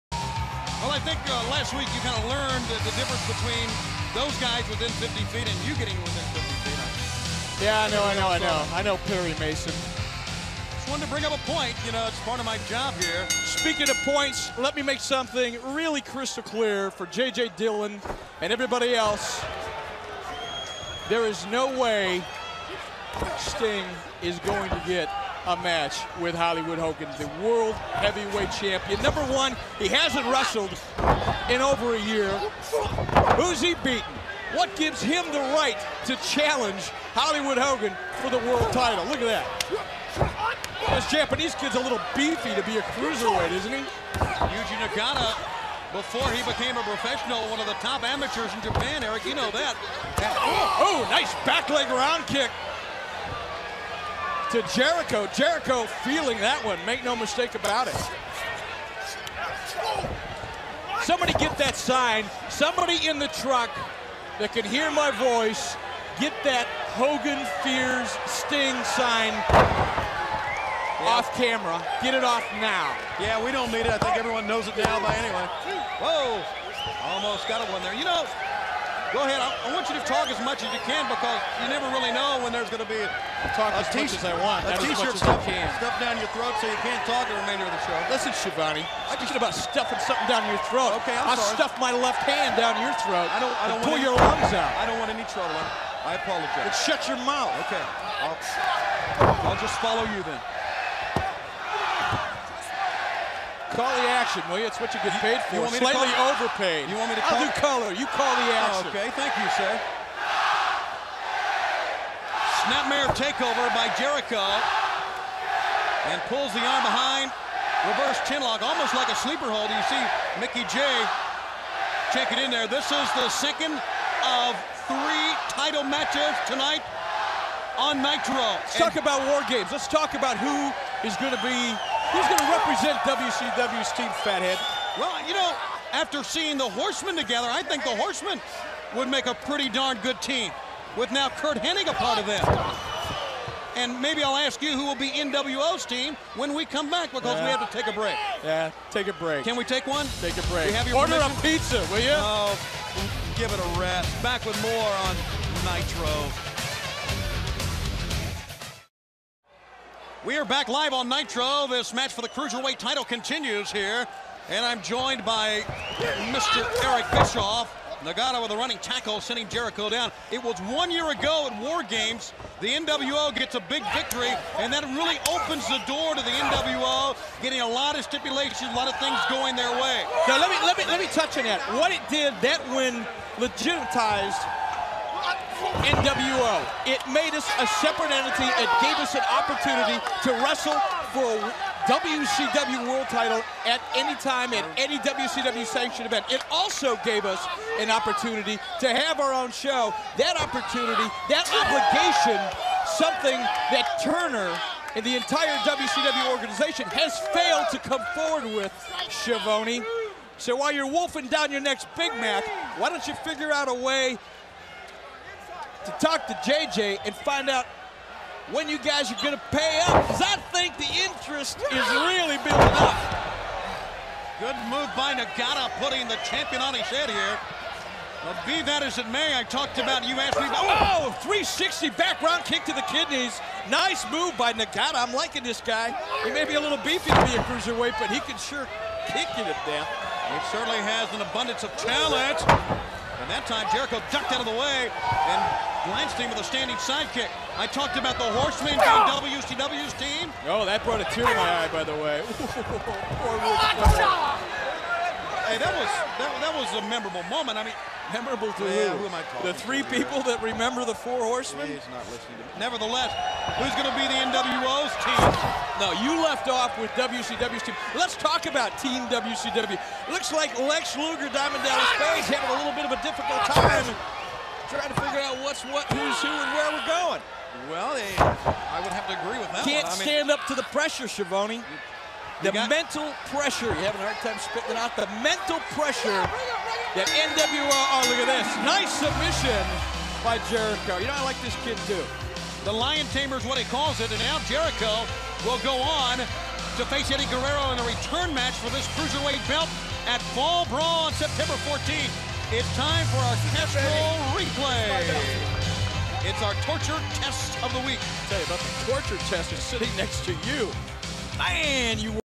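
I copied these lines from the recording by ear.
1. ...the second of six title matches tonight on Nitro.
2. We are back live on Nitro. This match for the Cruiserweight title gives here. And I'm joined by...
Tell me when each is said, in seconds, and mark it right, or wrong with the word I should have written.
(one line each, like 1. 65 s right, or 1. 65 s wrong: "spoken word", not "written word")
1. 123 s wrong: "three", not "six"
2. 160 s wrong: "continues", not "gives".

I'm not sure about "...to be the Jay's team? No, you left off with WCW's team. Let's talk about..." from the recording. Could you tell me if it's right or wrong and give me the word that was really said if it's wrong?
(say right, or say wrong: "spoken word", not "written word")
wrong: "NWO", not "Jay".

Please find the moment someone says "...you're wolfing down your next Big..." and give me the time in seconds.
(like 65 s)
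210 s.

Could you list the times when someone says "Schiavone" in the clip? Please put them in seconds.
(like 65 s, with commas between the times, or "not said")
88 s, 209 s, 281 s.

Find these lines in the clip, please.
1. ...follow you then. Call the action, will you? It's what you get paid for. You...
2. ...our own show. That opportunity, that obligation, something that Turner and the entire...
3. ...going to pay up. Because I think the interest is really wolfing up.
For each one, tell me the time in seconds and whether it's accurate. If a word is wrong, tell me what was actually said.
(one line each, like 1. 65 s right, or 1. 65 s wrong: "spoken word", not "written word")
1. 99 s right
2. 199 s right
3. 219 s wrong: "building", not "wolfing".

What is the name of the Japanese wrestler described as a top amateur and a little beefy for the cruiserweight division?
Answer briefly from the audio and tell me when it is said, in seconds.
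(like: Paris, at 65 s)
Yuji Nagata, at 44 s.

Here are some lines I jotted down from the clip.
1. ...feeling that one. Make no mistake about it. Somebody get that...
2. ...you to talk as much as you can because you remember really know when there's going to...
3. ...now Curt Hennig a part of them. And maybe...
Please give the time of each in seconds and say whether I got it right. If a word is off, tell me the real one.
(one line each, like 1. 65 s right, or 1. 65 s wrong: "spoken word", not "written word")
1. 56 s right
2. 79 s wrong: "never", not "remember"
3. 141 s right.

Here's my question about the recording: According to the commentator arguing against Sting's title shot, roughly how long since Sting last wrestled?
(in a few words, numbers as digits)
over a year.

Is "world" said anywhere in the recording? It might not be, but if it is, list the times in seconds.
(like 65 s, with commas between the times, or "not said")
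27 s, 38 s, 192 s.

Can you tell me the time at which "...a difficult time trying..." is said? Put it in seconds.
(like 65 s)
272 s.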